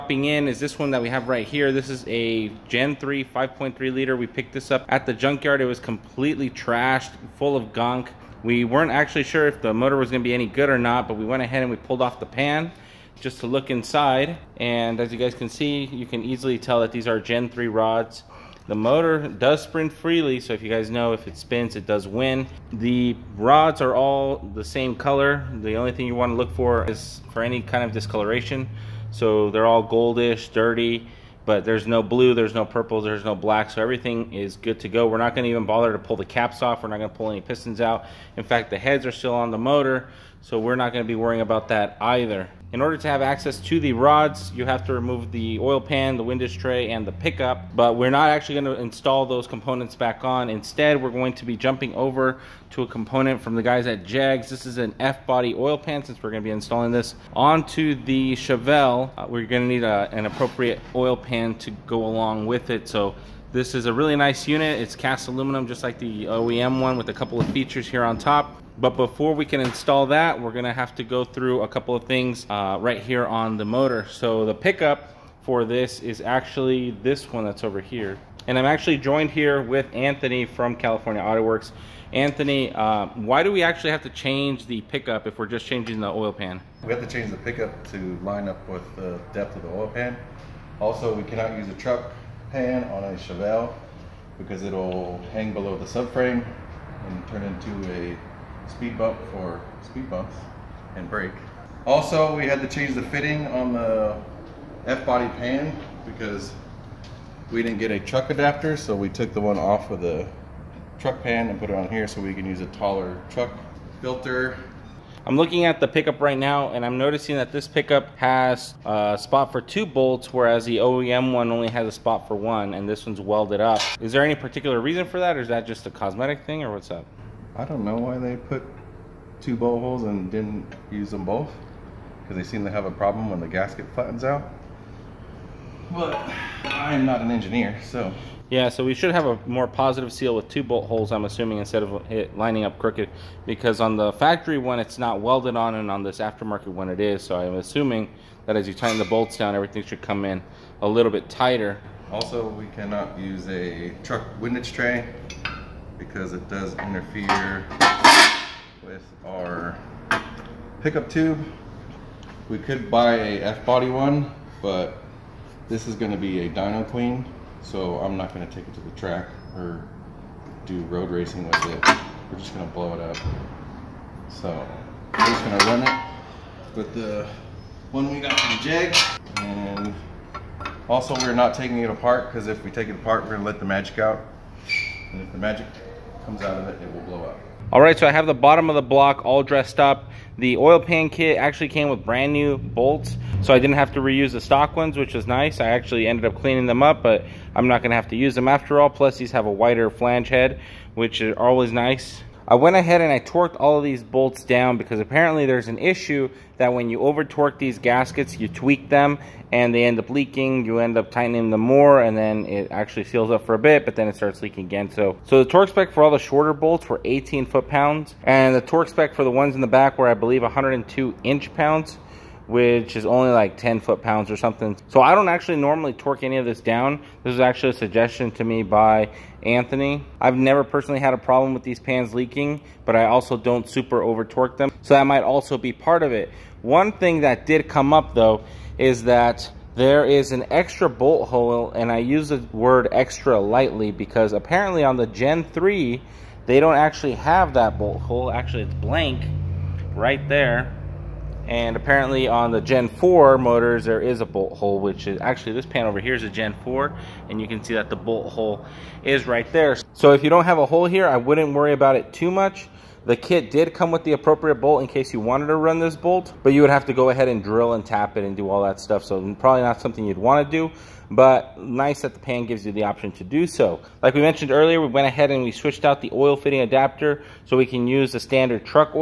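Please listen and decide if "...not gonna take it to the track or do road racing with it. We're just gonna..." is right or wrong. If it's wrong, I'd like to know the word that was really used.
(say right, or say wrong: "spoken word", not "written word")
right.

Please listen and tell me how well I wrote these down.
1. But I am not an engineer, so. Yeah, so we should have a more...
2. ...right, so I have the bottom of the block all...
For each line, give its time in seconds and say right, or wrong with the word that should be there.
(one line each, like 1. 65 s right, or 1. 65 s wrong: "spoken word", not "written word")
1. 135 s right
2. 187 s right.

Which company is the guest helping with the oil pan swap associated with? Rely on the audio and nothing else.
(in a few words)
California Auto Works.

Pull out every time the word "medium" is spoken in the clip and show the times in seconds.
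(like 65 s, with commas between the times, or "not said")
not said.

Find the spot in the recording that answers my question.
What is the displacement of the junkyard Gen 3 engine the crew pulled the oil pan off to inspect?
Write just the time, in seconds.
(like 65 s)
3 s.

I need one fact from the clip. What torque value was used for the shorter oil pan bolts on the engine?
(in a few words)
18 foot pounds.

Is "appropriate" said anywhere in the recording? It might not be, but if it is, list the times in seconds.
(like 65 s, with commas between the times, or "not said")
60 s, 264 s.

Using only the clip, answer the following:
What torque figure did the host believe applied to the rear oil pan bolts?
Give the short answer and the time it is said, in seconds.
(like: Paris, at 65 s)
102 inch pounds, at 220 s.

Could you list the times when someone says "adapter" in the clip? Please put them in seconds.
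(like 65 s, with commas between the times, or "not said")
108 s, 276 s.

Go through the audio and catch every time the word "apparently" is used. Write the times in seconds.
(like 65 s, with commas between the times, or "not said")
205 s, 244 s, 251 s.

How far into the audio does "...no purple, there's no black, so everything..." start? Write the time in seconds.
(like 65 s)
32 s.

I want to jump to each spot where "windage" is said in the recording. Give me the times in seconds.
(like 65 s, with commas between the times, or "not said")
46 s, 154 s.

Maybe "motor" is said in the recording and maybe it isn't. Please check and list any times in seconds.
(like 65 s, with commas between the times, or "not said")
9 s, 18 s, 39 s, 73 s, 253 s.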